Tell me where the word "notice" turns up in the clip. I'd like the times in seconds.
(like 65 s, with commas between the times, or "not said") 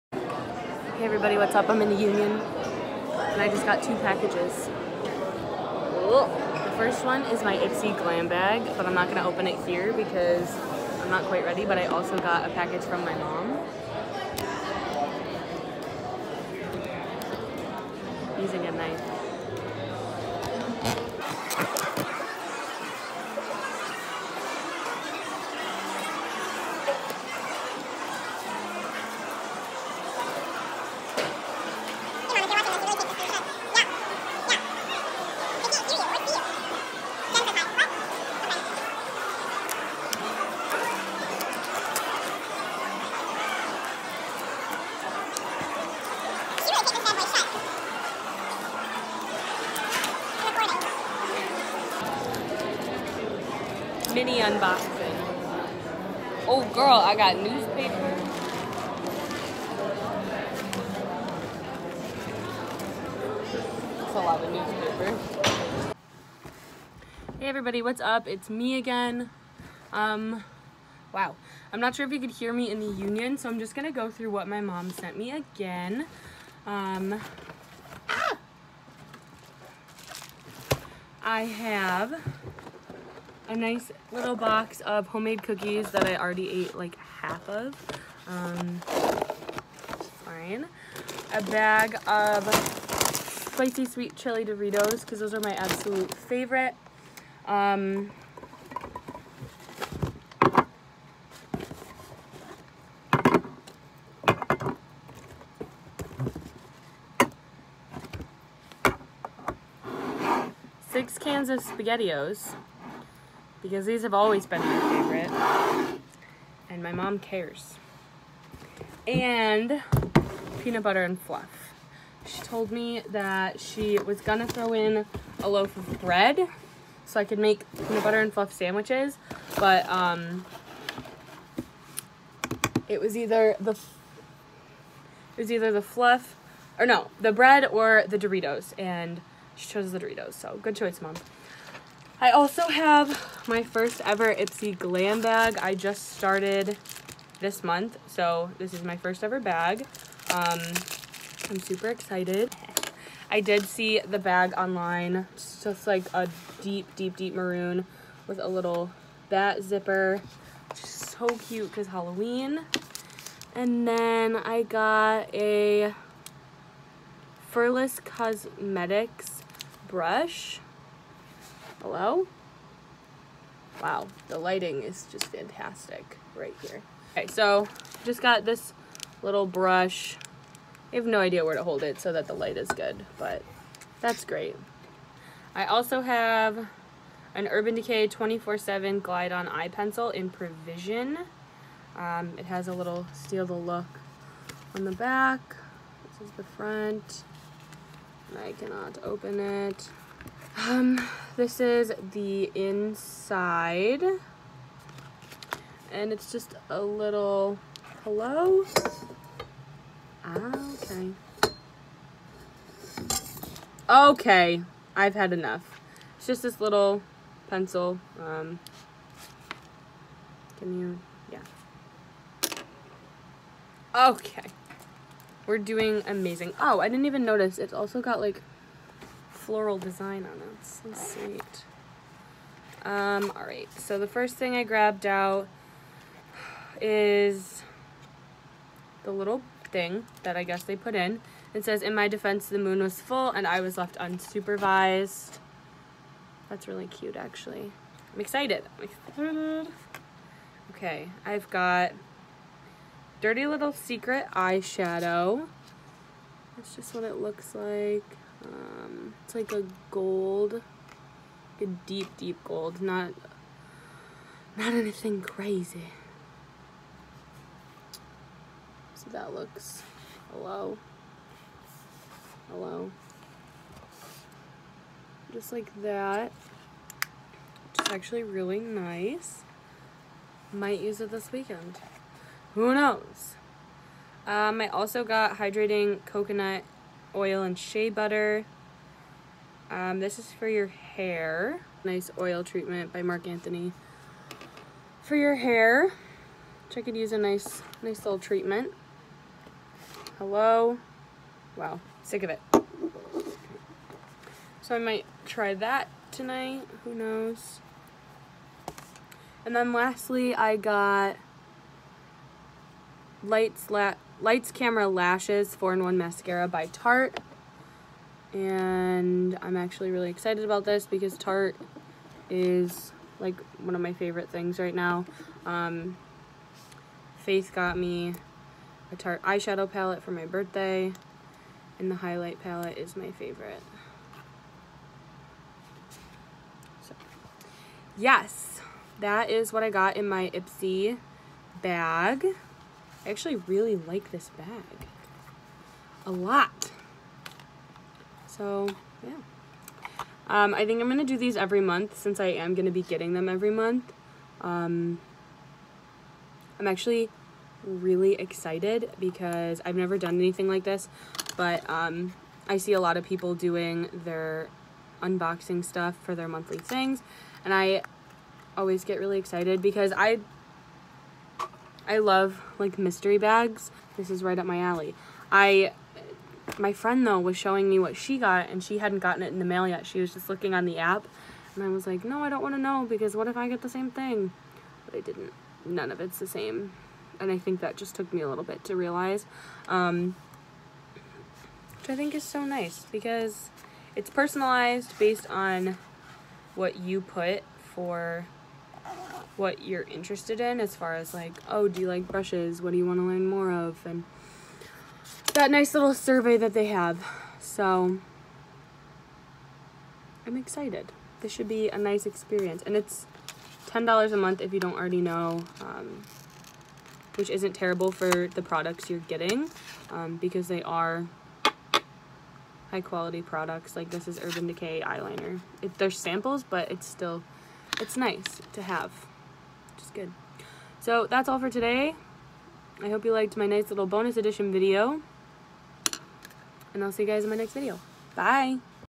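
227 s.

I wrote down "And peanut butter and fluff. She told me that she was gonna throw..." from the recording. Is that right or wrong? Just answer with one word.
right.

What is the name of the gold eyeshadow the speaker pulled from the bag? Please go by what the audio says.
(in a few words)
Dirty Little Secret.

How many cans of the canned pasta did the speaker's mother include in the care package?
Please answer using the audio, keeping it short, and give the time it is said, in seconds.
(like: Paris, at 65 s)
6, at 110 s.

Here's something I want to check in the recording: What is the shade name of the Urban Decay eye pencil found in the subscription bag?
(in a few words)
Perversion.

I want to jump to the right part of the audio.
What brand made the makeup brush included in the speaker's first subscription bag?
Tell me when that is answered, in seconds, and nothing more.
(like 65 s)
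167 s.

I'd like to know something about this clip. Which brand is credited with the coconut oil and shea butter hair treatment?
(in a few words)
Marc Anthony.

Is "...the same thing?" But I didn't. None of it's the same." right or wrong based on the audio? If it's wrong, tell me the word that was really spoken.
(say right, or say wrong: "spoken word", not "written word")
right.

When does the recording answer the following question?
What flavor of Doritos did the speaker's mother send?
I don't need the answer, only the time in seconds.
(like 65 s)
93 s.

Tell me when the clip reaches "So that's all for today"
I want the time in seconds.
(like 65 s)
430 s.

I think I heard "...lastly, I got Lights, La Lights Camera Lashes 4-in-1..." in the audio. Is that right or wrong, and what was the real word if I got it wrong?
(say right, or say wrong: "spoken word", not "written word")
right.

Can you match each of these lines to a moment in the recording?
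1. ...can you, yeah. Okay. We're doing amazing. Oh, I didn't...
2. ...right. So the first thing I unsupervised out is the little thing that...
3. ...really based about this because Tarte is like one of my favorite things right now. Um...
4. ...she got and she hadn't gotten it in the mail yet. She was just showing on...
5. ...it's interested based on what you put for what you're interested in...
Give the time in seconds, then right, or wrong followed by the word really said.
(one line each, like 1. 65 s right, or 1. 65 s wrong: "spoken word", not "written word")
1. 220 s right
2. 233 s wrong: "grabbed", not "unsupervised"
3. 319 s wrong: "excited", not "based"
4. 377 s wrong: "looking", not "showing"
5. 393 s wrong: "personalized", not "interested".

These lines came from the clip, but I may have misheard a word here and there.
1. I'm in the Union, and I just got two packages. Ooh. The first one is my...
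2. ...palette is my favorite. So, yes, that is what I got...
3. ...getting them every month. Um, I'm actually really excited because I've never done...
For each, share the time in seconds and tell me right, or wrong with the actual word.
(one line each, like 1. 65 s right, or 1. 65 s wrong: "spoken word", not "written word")
1. 1 s right
2. 332 s right
3. 352 s right.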